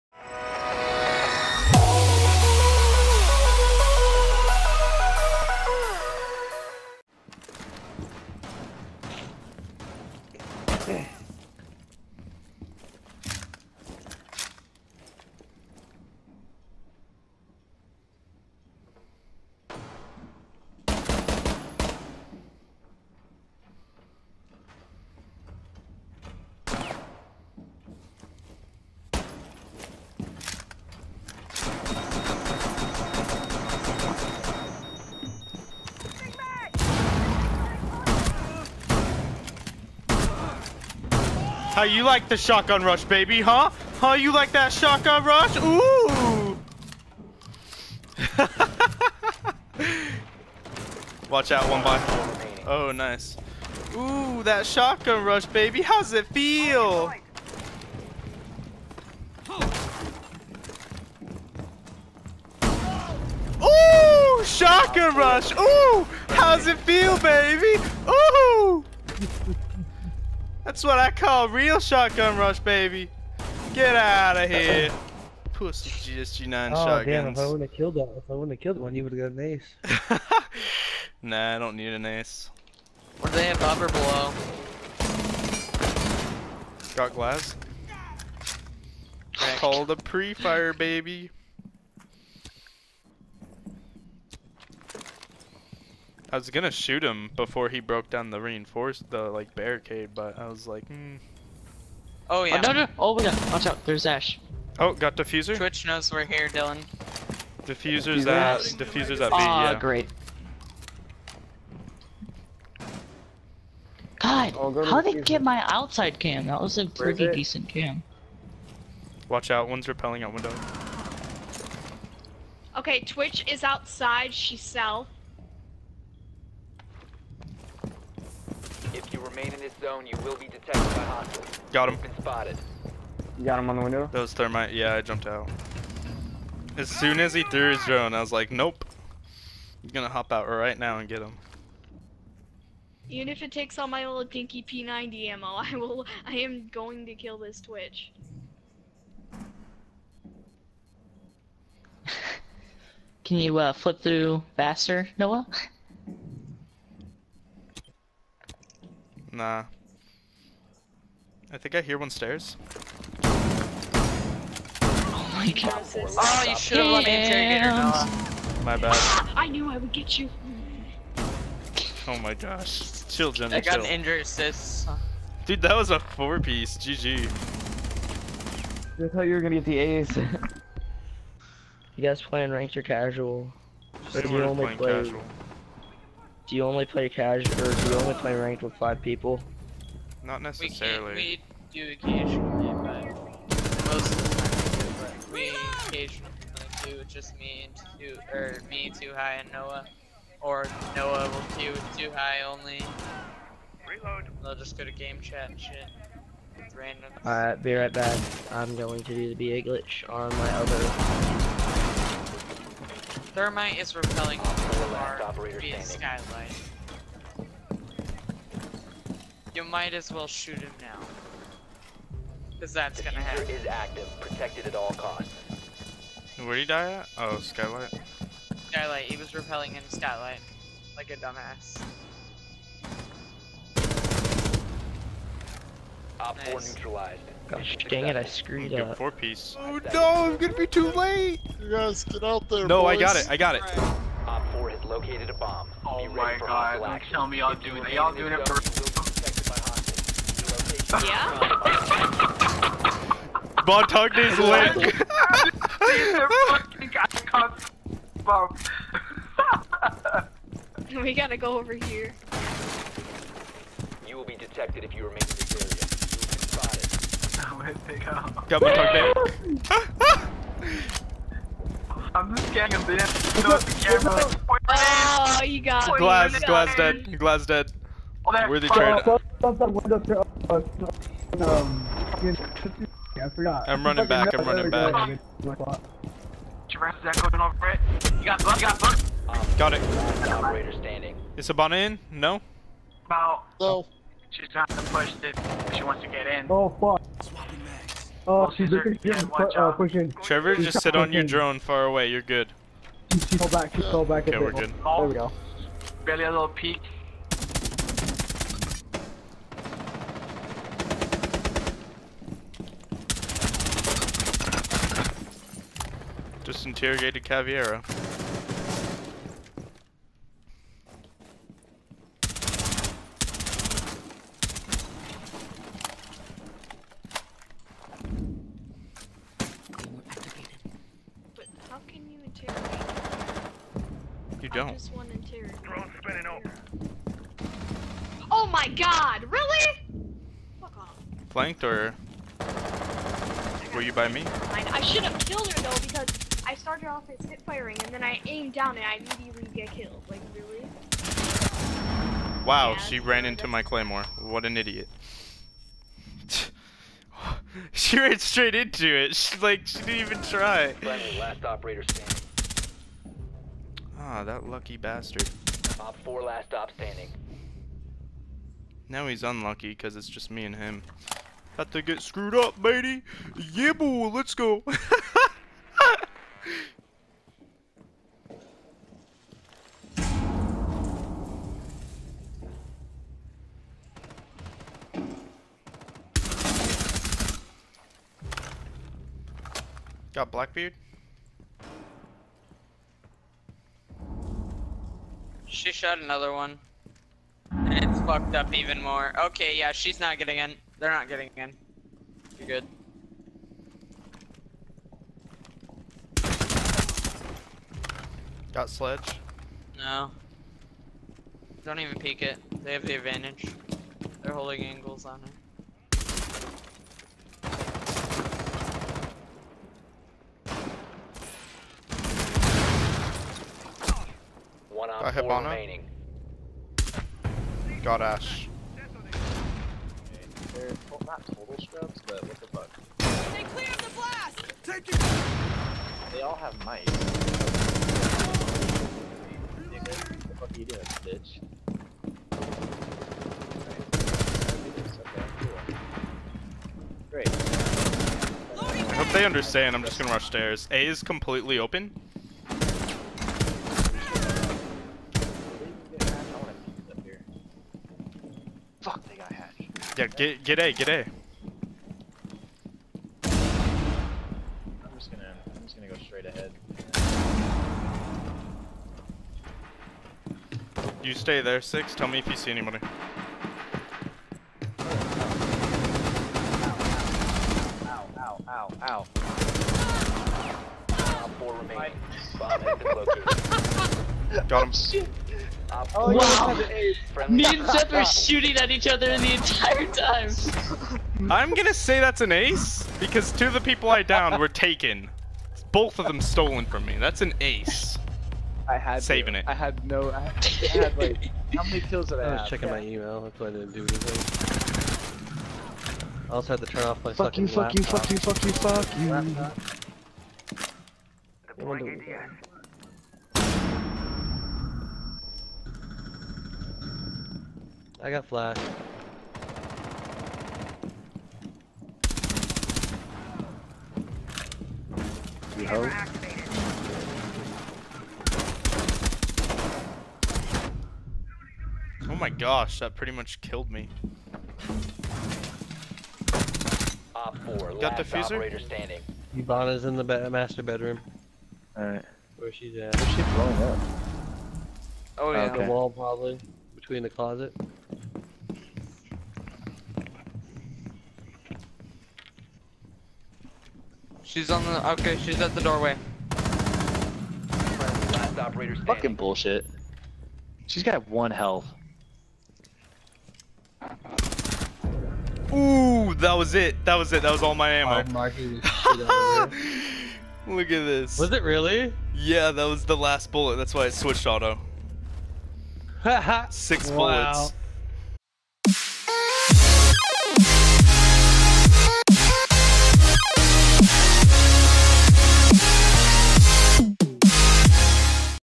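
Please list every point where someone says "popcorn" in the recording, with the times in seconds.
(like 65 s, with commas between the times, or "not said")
not said.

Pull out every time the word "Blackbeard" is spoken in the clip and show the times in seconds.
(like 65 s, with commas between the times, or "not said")
390 s.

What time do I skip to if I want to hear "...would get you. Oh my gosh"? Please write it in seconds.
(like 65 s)
169 s.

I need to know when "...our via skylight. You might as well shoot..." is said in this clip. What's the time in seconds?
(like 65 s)
214 s.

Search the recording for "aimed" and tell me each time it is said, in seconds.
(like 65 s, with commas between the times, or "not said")
348 s.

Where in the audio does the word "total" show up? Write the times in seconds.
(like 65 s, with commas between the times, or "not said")
431 s.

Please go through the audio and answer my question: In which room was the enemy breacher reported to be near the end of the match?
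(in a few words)
Master bedroom.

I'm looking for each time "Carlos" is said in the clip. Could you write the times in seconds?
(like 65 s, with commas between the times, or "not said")
not said.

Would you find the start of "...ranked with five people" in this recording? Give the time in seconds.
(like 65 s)
188 s.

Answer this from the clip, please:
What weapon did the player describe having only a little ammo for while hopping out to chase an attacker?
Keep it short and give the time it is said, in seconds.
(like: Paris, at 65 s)
P90, at 144 s.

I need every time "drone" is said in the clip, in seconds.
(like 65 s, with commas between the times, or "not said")
137 s, 301 s, 335 s.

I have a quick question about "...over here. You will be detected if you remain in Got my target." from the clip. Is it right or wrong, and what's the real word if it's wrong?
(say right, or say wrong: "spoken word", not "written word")
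right.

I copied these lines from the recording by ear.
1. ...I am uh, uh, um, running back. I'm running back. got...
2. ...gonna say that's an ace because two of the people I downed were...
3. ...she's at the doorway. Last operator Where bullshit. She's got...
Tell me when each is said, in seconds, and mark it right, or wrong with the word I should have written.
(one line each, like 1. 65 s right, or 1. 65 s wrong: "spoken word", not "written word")
1. 278 s right
2. 491 s right
3. 555 s wrong: "Fucking", not "Where".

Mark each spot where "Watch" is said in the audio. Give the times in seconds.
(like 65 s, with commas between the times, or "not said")
51 s, 103 s, 119 s.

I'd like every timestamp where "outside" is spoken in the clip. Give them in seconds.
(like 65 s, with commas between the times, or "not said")
115 s, 123 s.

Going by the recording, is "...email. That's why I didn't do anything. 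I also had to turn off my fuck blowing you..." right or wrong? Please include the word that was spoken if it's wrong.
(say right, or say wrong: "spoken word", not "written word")
wrong: "fucking", not "blowing".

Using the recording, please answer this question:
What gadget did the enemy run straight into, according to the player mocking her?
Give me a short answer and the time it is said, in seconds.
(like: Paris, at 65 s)
Claymore, at 353 s.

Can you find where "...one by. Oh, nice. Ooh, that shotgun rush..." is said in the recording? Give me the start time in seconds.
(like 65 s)
51 s.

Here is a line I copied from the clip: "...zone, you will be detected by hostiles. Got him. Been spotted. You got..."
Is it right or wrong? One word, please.
right.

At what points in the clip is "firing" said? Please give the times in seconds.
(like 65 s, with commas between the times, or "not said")
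347 s.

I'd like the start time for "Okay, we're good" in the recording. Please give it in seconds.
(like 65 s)
304 s.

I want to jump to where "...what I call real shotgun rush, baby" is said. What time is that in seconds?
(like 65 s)
70 s.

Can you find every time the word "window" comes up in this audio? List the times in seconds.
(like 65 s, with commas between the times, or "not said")
120 s, 133 s.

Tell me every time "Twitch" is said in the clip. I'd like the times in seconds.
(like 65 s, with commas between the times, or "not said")
105 s, 123 s, 147 s.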